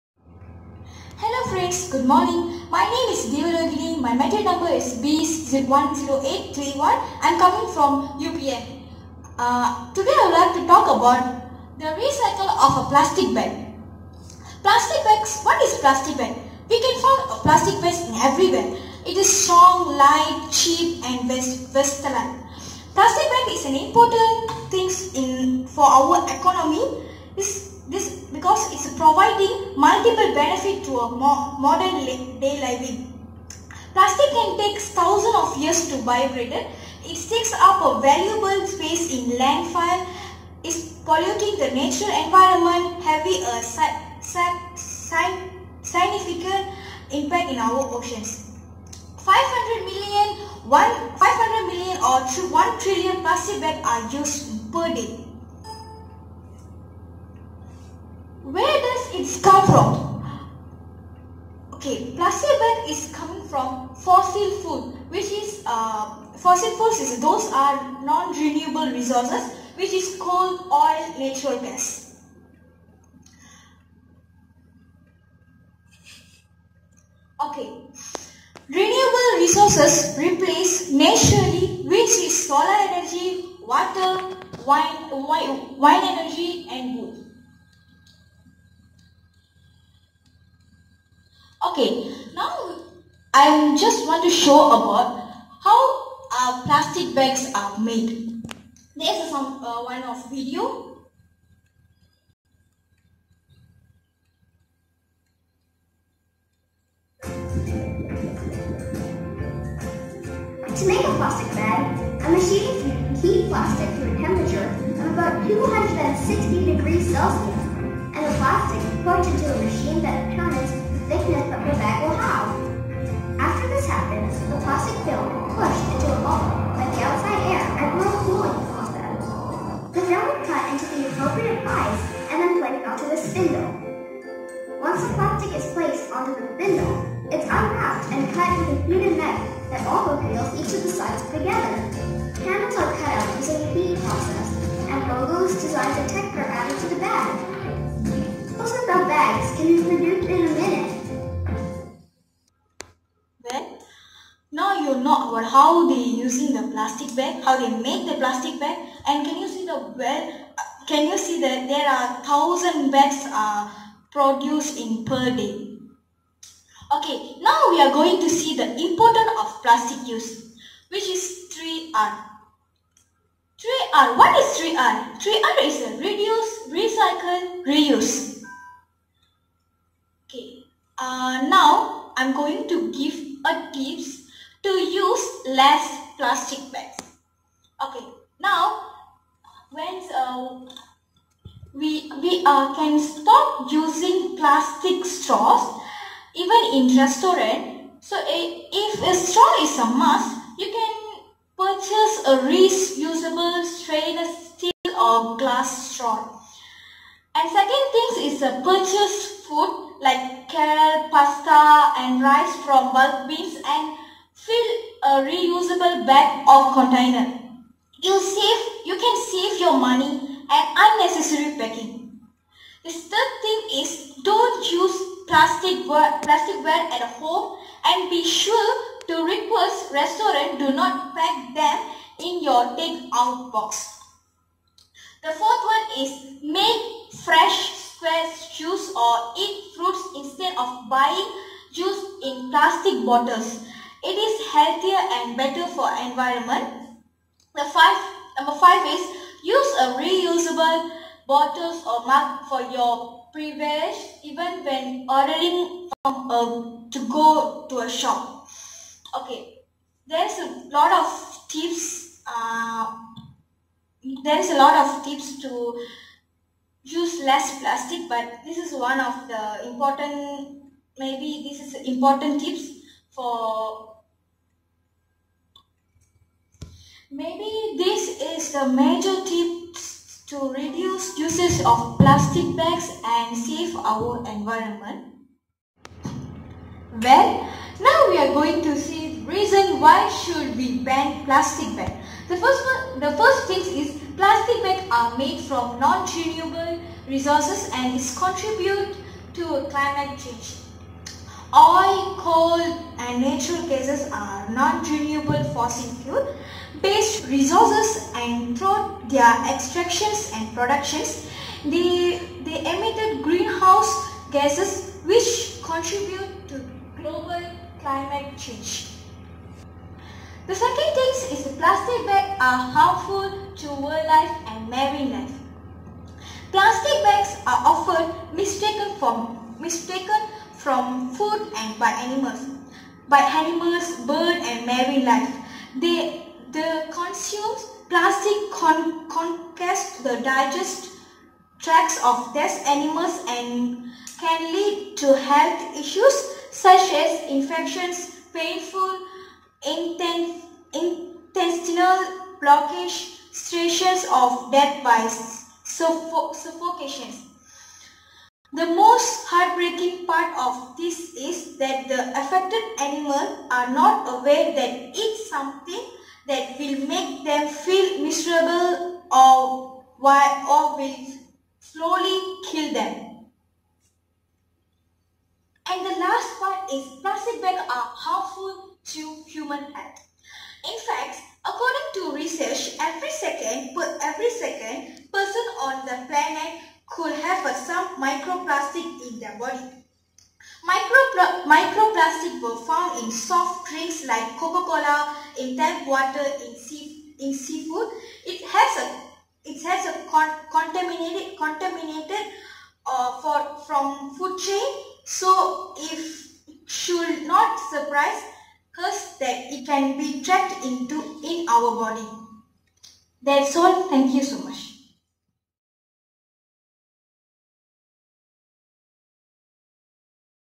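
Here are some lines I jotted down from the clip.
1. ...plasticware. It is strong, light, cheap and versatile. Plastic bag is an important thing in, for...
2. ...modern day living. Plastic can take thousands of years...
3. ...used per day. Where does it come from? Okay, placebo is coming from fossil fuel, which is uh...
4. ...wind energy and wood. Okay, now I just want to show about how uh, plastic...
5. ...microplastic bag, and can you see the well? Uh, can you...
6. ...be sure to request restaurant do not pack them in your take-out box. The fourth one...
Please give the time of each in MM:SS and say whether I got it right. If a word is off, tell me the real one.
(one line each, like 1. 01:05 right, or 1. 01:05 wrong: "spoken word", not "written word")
1. 00:18 wrong: "everywhere", not "plasticware"
2. 00:31 right
3. 00:54 right
4. 01:25 right
5. 02:38 wrong: "plastic", not "microplastic"
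6. 03:48 right.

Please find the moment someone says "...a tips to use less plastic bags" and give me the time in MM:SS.
03:03.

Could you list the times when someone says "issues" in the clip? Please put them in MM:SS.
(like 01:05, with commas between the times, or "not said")
05:45.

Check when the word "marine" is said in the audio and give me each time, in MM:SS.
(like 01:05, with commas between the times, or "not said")
05:24, 05:34.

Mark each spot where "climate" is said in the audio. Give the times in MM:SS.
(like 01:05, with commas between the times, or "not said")
04:59, 05:17.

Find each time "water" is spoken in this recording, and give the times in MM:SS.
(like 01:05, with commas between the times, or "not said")
01:23, 06:35.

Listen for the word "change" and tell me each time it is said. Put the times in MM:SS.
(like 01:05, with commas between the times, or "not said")
05:00, 05:18.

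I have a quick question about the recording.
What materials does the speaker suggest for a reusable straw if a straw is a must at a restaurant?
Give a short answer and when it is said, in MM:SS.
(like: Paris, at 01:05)
stainless steel or glass, at 03:23.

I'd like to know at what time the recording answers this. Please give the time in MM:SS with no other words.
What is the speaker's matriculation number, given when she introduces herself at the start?
00:04.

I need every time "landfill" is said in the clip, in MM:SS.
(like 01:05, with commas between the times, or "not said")
00:39.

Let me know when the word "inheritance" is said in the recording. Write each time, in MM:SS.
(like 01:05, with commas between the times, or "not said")
not said.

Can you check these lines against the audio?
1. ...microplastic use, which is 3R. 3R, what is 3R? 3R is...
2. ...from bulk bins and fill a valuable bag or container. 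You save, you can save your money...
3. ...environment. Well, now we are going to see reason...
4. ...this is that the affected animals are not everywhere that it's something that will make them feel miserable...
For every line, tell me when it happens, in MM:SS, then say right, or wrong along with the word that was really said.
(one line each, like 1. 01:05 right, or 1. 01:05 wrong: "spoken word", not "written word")
1. 02:49 wrong: "plastic", not "microplastic"
2. 03:32 wrong: "reusable", not "valuable"
3. 04:44 right
4. 06:00 wrong: "aware", not "everywhere".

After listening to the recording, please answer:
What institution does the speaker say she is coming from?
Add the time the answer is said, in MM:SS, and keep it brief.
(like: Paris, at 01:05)
UPN, at 00:08.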